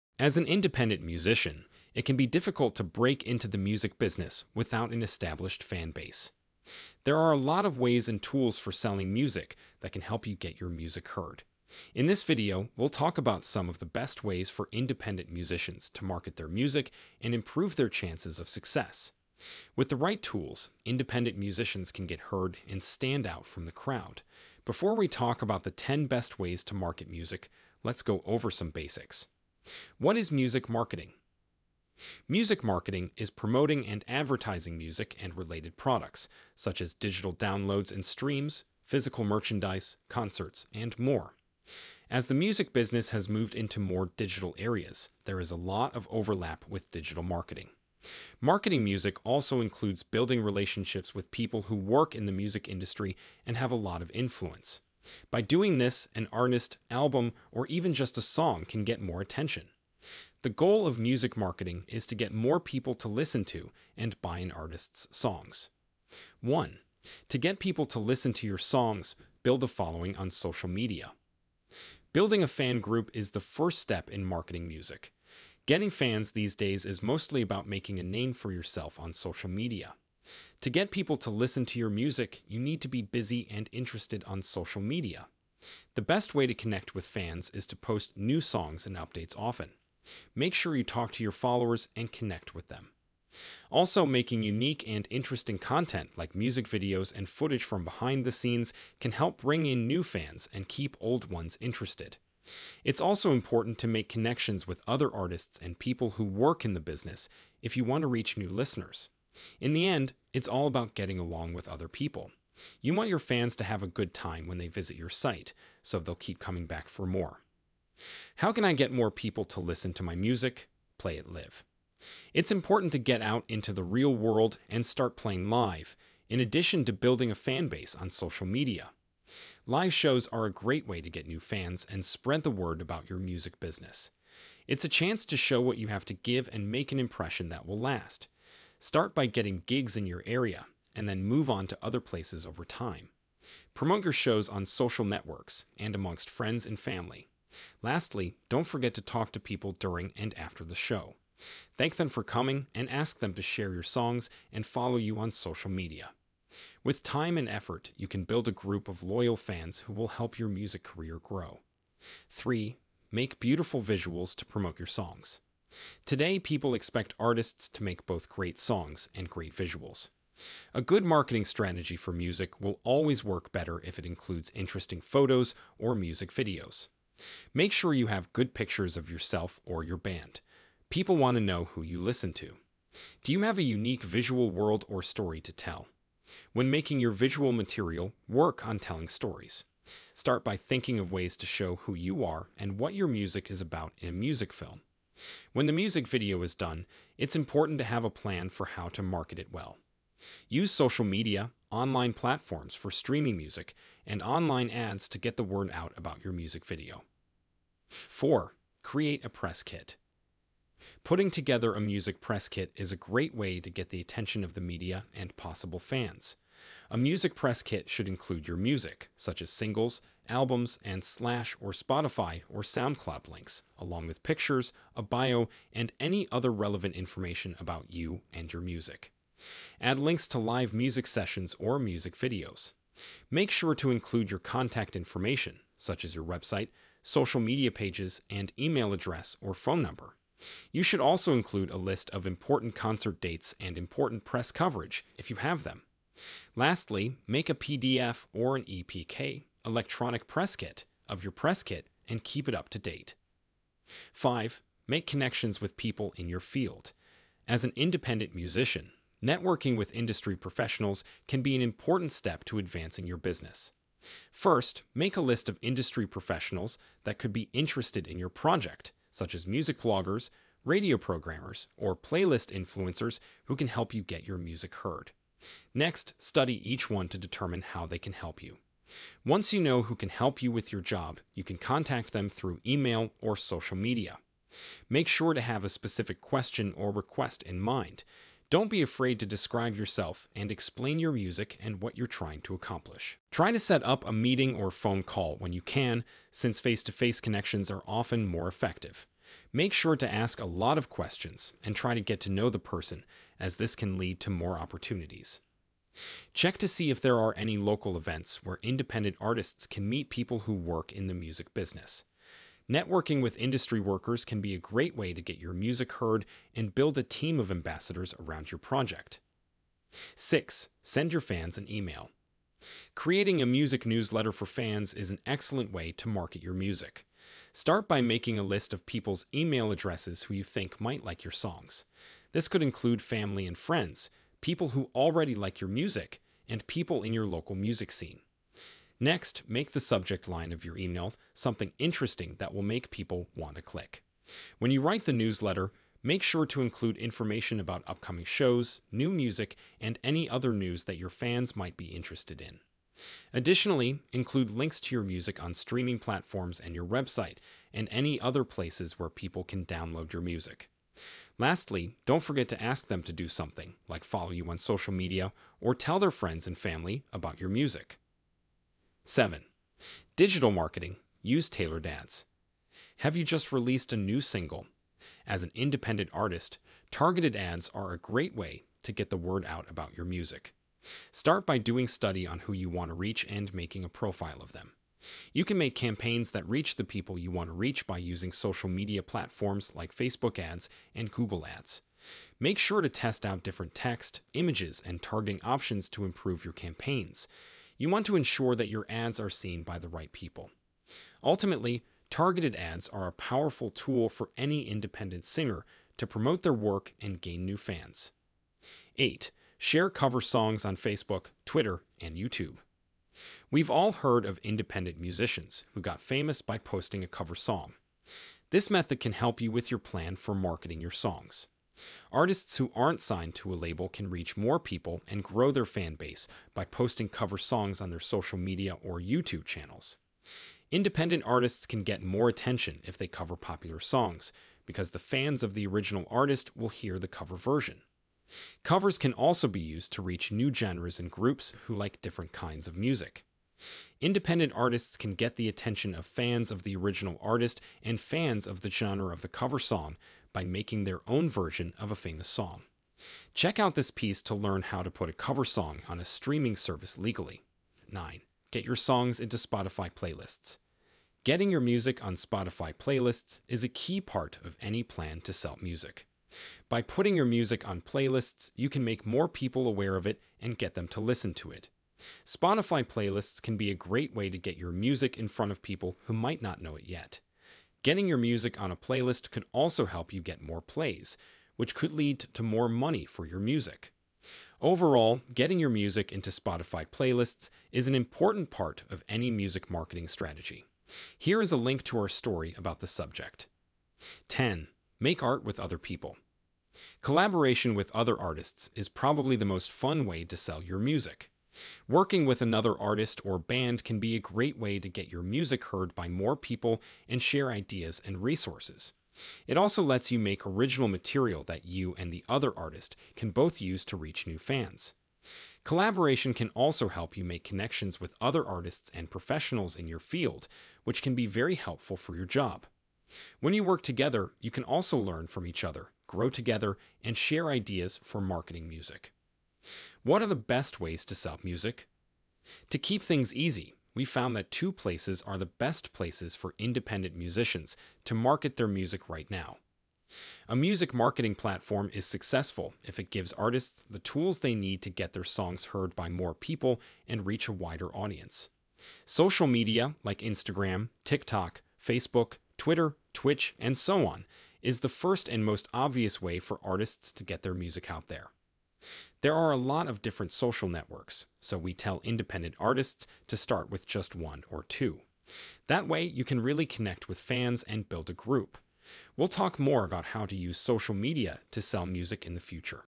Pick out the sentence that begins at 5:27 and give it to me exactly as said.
Start by making a list of people's email addresses who you think might like your songs.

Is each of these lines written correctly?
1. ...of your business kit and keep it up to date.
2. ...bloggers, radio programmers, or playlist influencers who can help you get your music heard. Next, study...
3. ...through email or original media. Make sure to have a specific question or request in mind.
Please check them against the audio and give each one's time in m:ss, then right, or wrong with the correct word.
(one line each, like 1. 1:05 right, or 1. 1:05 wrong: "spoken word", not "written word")
1. 4:11 wrong: "press", not "business"
2. 4:29 right
3. 4:42 wrong: "social", not "original".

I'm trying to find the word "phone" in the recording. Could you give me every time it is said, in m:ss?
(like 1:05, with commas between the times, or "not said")
3:59, 4:54.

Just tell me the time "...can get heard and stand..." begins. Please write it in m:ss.
0:21.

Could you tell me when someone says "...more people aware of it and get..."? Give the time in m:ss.
7:49.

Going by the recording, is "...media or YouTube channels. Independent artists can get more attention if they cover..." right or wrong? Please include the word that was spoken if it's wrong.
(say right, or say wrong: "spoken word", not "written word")
right.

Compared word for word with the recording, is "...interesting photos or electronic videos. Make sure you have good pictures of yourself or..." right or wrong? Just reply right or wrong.
wrong.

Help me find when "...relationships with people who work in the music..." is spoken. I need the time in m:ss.
0:50.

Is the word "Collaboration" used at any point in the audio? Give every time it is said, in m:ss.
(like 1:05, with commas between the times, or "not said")
8:17, 8:35.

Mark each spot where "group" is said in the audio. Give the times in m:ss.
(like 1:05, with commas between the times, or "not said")
1:12, 2:38, 7:21, 9:28.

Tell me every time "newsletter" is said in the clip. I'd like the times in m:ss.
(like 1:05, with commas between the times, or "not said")
5:23, 5:45.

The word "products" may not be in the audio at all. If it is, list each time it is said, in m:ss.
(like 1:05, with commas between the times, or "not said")
0:35.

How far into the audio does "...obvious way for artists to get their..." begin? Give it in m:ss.
9:15.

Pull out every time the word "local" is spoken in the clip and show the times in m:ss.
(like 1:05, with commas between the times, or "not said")
5:07, 5:37.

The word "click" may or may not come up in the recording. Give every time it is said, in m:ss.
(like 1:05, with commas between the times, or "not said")
5:43.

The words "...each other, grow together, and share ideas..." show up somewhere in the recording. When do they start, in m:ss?
8:45.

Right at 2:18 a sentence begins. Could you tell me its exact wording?
Start by getting gigs in your area and then move on to other places over time.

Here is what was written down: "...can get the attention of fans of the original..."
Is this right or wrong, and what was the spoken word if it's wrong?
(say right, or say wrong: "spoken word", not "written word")
right.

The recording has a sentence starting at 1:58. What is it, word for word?
How can I get more people to listen to my music, play it live?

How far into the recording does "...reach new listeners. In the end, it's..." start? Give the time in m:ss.
1:48.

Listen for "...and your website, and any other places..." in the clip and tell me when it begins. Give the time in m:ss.
5:56.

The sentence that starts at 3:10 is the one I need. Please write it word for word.
Start by thinking of ways to show who you are and what your music is about in a music film.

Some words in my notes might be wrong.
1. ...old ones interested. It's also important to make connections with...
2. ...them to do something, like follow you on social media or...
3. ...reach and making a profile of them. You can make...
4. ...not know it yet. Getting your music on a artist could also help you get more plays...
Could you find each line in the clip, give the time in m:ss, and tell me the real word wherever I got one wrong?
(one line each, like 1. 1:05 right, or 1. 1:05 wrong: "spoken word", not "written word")
1. 1:41 right
2. 6:02 right
3. 6:22 right
4. 7:56 wrong: "playlist", not "artist".